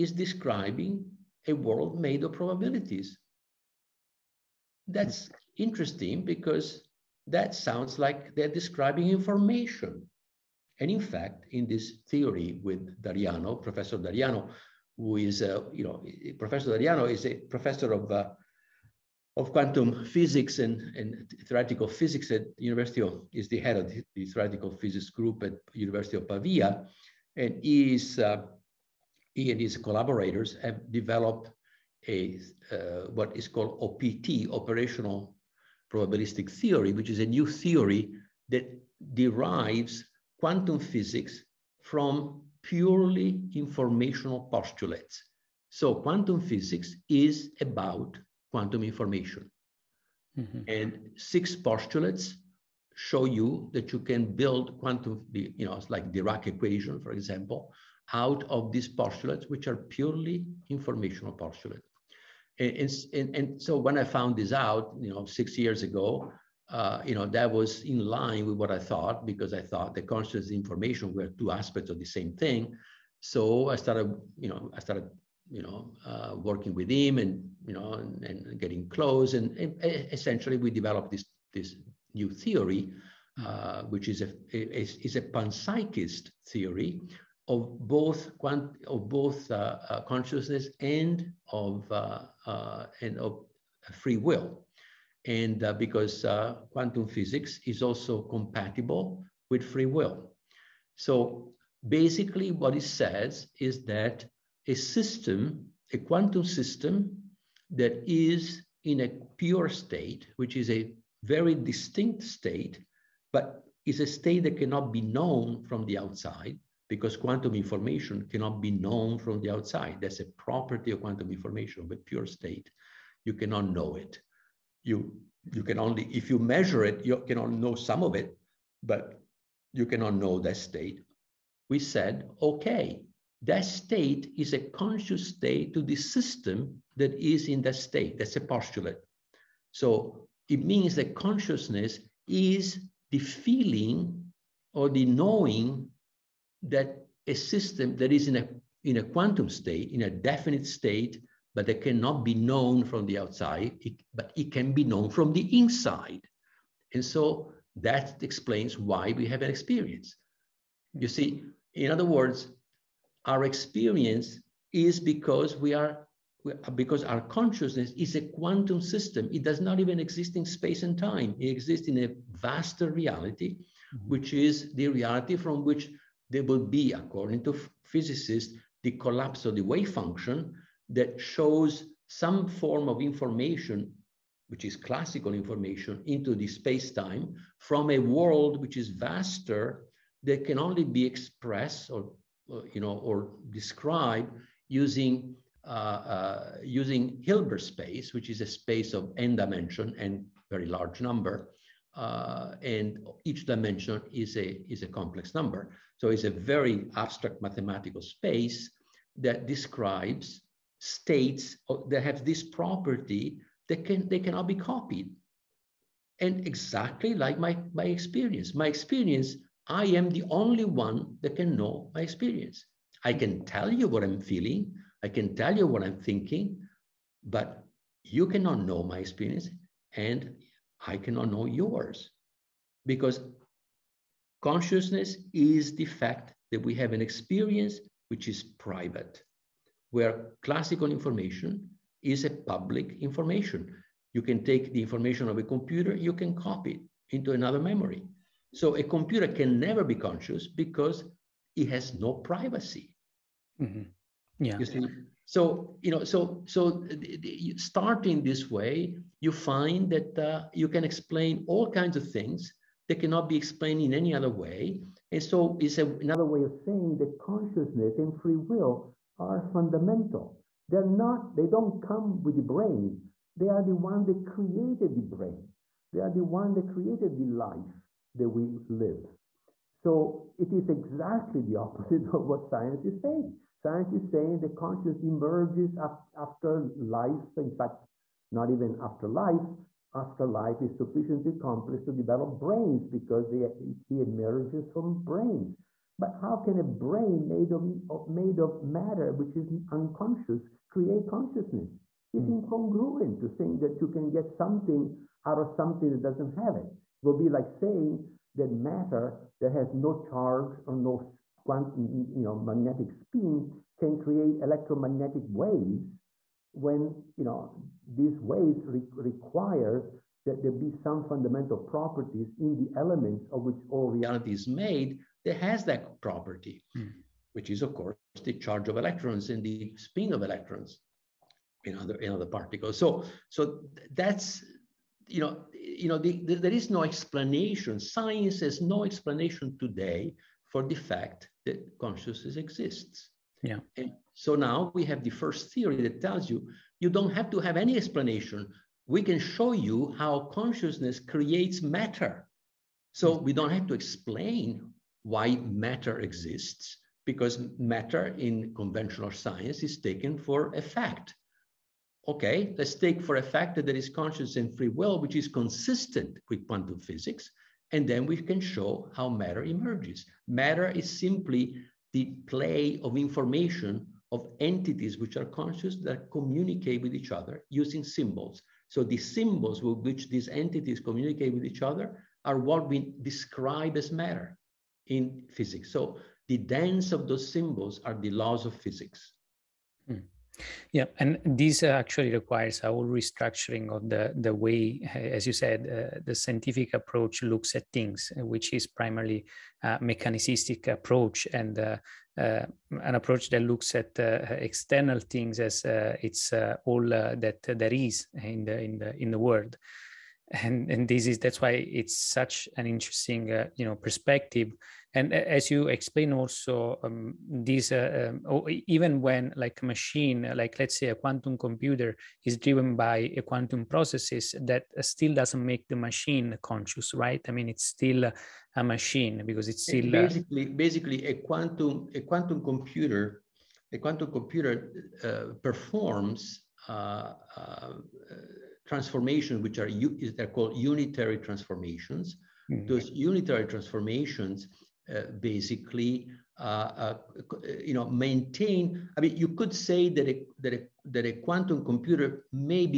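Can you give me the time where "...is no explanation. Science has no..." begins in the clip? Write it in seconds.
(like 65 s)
336 s.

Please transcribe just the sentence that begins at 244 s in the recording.
You can take the information of a computer, you can copy it into another memory.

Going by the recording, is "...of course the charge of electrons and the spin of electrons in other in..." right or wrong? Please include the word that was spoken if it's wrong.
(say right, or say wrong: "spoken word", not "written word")
right.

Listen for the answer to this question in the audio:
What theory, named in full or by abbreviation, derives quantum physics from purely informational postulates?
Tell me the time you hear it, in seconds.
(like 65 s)
33 s.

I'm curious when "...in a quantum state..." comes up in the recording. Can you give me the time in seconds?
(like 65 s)
148 s.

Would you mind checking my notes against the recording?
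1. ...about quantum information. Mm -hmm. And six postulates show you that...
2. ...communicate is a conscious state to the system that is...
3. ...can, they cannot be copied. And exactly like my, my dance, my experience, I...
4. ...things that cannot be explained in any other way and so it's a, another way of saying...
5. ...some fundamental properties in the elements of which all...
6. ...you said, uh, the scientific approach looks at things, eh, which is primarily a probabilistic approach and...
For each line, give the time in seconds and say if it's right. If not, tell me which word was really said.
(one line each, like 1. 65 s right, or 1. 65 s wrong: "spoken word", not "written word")
1. 47 s right
2. 133 s wrong: "state", not "communicate"
3. 213 s wrong: "experience", not "dance"
4. 262 s right
5. 320 s right
6. 395 s wrong: "mechanistic", not "probabilistic".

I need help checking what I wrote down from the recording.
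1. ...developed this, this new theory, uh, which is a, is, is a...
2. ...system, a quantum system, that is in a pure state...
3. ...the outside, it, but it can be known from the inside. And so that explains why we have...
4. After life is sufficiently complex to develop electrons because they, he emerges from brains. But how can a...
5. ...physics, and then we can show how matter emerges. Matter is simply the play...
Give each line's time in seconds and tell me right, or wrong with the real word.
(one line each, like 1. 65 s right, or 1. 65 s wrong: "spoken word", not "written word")
1. 80 s right
2. 104 s right
3. 153 s right
4. 289 s wrong: "brains", not "electrons"
5. 366 s right.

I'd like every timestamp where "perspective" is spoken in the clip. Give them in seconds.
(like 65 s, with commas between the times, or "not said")
413 s.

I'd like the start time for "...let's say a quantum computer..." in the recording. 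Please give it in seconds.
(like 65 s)
420 s.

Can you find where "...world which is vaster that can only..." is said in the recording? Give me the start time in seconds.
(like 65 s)
187 s.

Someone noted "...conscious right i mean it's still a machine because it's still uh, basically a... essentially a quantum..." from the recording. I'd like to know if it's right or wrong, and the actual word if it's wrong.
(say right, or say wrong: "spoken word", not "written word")
wrong: "basically", not "essentially".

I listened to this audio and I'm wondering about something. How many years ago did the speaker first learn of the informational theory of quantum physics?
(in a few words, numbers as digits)
6.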